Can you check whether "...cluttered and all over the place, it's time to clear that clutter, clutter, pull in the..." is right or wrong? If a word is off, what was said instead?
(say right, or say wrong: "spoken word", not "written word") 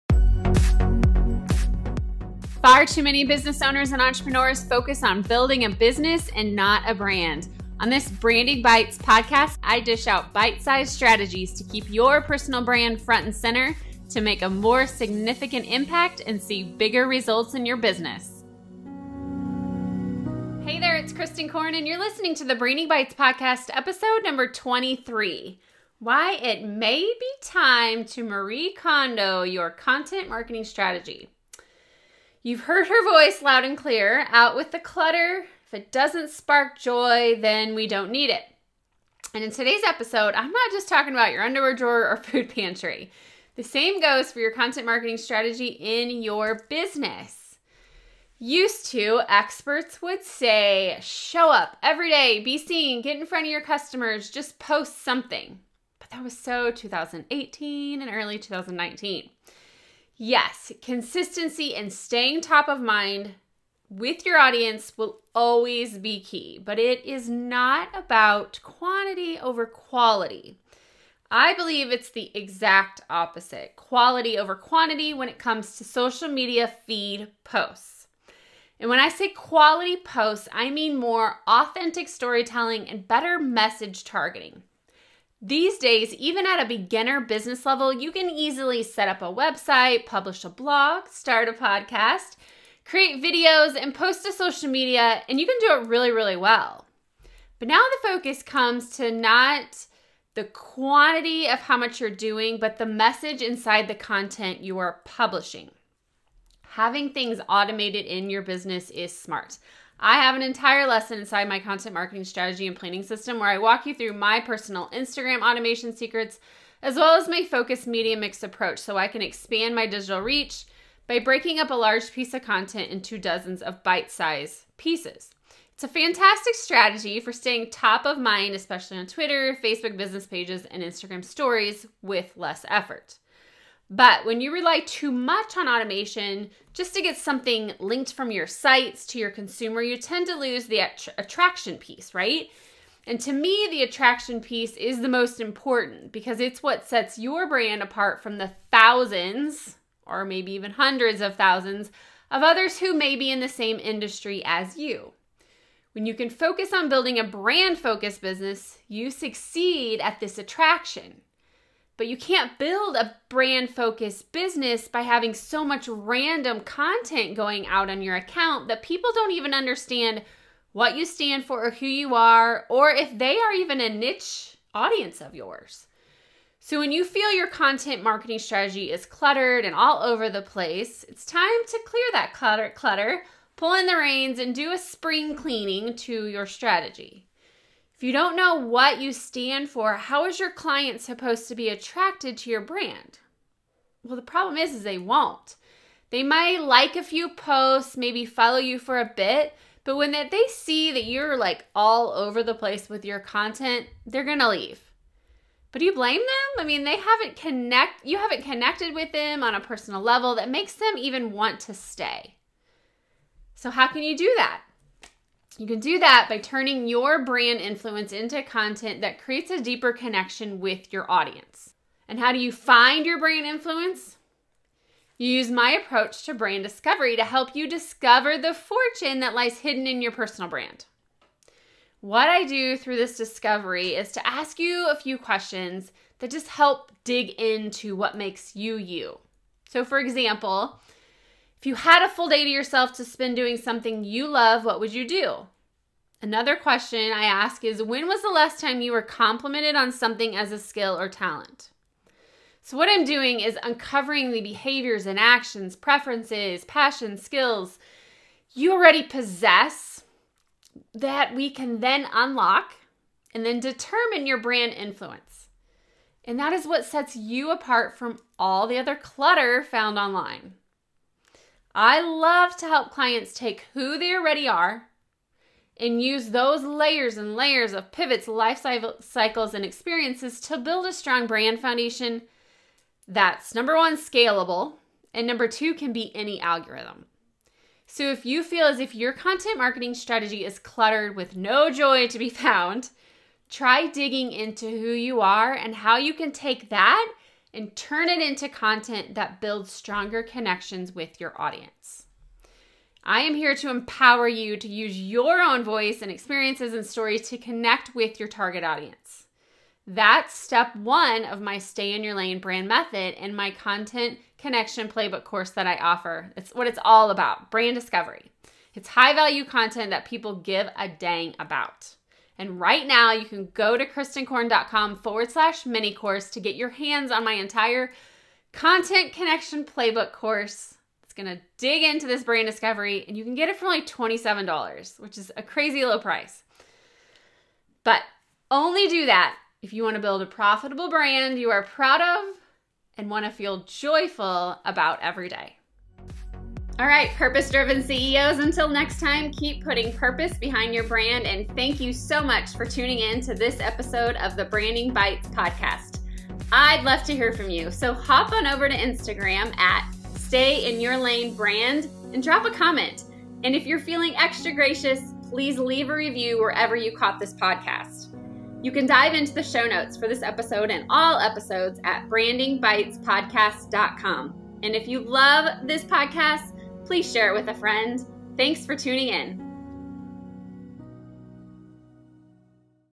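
right.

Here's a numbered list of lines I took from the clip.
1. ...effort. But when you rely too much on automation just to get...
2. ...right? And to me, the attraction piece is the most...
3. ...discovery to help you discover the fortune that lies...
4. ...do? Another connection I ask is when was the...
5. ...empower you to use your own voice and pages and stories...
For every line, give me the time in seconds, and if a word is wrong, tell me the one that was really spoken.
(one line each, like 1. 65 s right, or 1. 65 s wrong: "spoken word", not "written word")
1. 132 s right
2. 142 s right
3. 226 s right
4. 245 s wrong: "question", not "connection"
5. 303 s wrong: "experiences", not "pages".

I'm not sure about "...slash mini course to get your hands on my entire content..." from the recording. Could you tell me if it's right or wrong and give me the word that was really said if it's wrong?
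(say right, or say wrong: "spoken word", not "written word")
right.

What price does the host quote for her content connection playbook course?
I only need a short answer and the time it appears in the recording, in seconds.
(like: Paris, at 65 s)
$27, at 333 s.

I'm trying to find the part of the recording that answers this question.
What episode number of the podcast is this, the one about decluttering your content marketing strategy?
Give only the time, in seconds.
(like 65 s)
23 s.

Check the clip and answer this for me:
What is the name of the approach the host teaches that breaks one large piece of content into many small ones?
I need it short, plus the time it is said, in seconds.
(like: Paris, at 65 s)
focused media mix approach, at 117 s.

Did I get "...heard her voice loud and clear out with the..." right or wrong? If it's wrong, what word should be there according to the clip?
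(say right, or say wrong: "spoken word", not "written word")
right.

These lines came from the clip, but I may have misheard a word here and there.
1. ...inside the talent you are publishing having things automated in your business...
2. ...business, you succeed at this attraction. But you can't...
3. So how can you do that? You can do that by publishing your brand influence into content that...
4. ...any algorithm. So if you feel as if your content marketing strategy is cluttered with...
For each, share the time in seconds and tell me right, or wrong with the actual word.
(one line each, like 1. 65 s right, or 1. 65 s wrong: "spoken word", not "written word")
1. 103 s wrong: "content", not "talent"
2. 158 s right
3. 213 s wrong: "turning", not "publishing"
4. 286 s right.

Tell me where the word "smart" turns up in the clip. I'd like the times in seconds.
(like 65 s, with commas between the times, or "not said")
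109 s.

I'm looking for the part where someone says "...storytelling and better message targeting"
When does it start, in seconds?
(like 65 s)
82 s.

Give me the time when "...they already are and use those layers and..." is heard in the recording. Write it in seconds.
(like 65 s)
273 s.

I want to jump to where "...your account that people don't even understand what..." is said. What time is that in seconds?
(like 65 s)
168 s.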